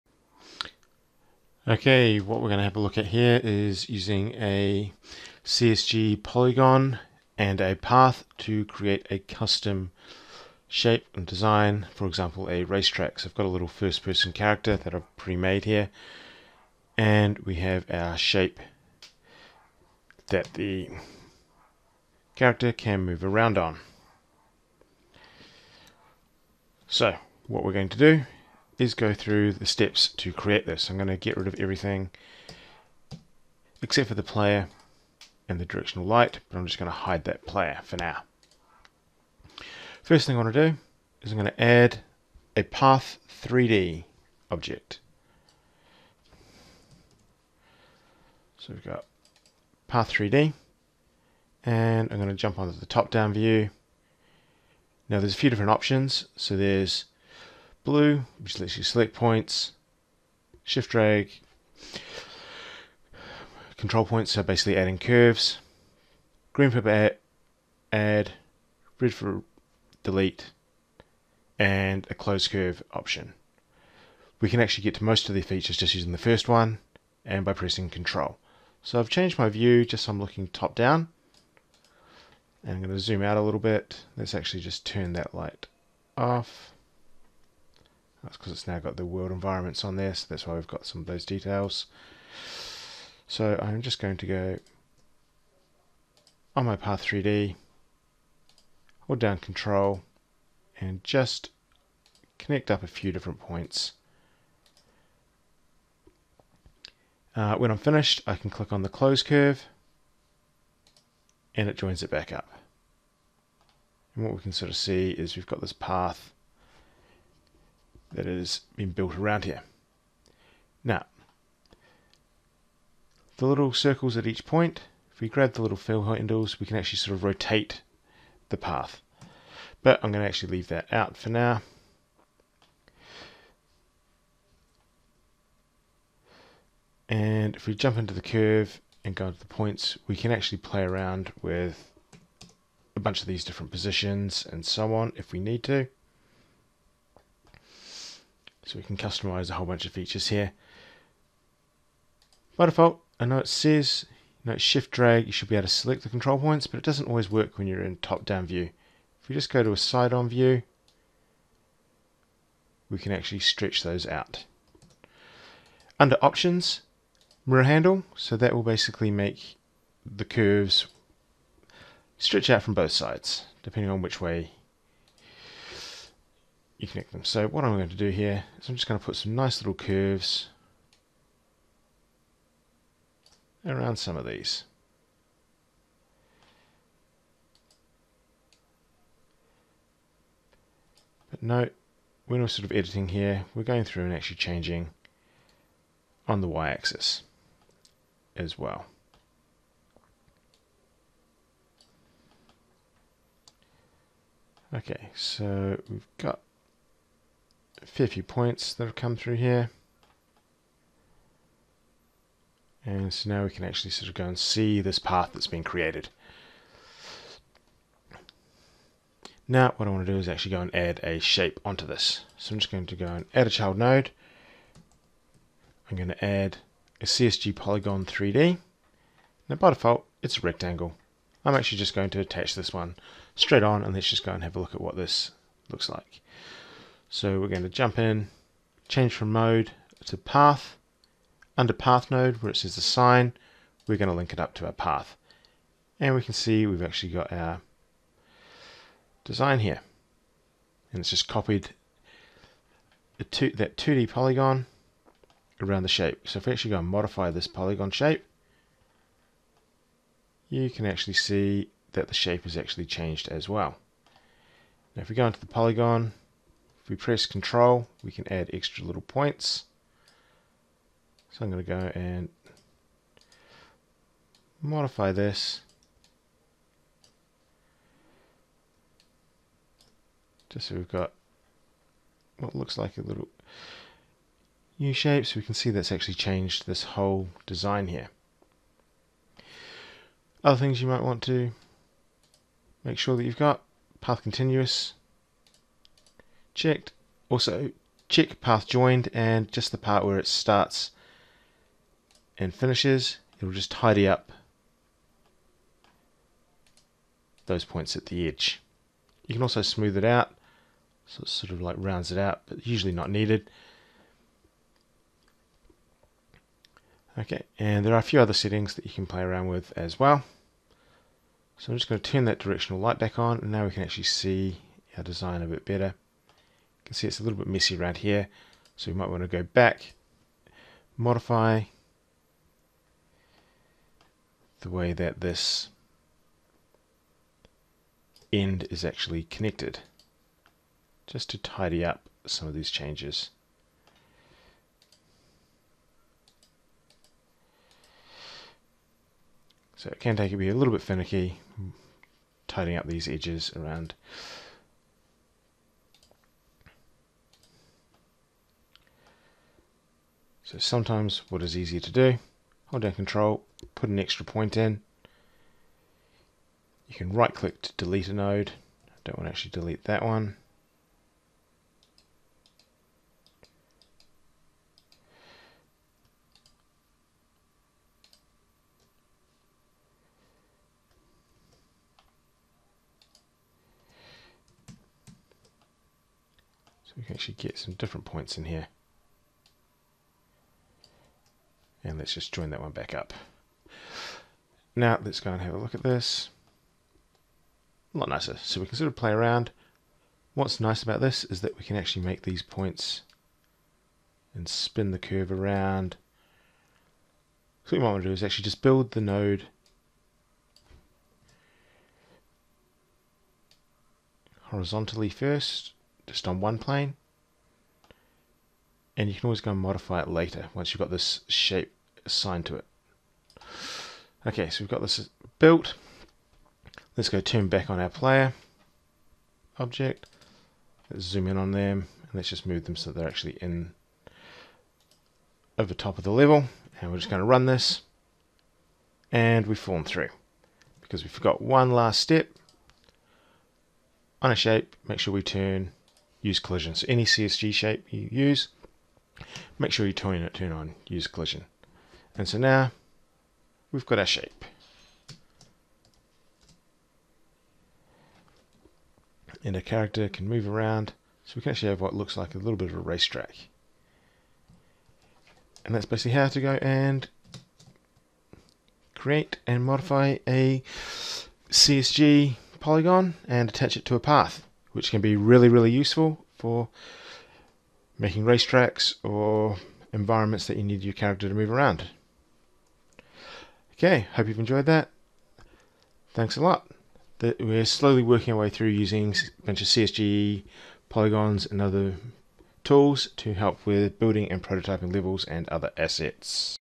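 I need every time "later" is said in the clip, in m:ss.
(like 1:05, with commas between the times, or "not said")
7:00.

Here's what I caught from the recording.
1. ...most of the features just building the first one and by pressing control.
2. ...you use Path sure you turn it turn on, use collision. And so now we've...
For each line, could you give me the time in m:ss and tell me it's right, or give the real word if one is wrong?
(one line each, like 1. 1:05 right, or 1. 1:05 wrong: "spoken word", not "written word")
1. 1:15 wrong: "using", not "building"
2. 7:27 wrong: "Make", not "Path".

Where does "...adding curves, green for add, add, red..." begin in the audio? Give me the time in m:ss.
1:04.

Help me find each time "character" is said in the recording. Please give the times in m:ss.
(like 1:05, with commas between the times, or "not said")
0:14, 0:22, 7:39, 8:00.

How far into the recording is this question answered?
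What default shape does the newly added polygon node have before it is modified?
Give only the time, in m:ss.
3:50.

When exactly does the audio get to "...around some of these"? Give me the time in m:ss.
3:03.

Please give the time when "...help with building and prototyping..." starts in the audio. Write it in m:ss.
8:13.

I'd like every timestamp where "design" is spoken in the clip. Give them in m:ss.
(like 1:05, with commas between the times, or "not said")
0:11, 4:09, 4:47, 5:25.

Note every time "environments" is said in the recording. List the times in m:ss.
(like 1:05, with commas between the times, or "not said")
1:29, 7:59.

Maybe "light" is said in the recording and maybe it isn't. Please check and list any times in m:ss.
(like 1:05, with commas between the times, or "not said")
0:36, 1:25, 5:22.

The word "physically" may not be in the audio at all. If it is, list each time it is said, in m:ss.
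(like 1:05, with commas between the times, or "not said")
not said.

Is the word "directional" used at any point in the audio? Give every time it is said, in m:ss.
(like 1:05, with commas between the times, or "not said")
0:35, 5:22.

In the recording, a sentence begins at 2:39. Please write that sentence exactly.
If we just go to a side on view, we can actually stretch those out.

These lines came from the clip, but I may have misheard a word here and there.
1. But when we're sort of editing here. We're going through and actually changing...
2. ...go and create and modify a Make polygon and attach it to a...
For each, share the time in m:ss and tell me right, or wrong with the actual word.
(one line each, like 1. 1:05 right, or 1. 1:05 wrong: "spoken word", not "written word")
1. 3:11 right
2. 7:46 wrong: "CSG", not "Make".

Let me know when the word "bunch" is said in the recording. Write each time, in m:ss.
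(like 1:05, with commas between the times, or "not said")
2:22, 2:29, 8:09.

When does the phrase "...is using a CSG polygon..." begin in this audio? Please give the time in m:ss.
0:03.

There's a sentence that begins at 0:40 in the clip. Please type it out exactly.
First thing I want to do is I'm going to add a path 3D object.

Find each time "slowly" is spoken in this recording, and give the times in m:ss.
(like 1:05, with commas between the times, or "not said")
8:07.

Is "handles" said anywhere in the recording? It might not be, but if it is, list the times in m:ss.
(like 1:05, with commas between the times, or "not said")
2:06, 2:47.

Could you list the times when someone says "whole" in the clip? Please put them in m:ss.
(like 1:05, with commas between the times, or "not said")
2:29, 4:46.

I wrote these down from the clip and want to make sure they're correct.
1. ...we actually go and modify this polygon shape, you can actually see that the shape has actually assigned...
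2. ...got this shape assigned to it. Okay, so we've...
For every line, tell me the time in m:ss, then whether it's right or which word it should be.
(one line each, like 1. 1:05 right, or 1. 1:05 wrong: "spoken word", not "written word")
1. 4:16 wrong: "changed", not "assigned"
2. 7:00 right.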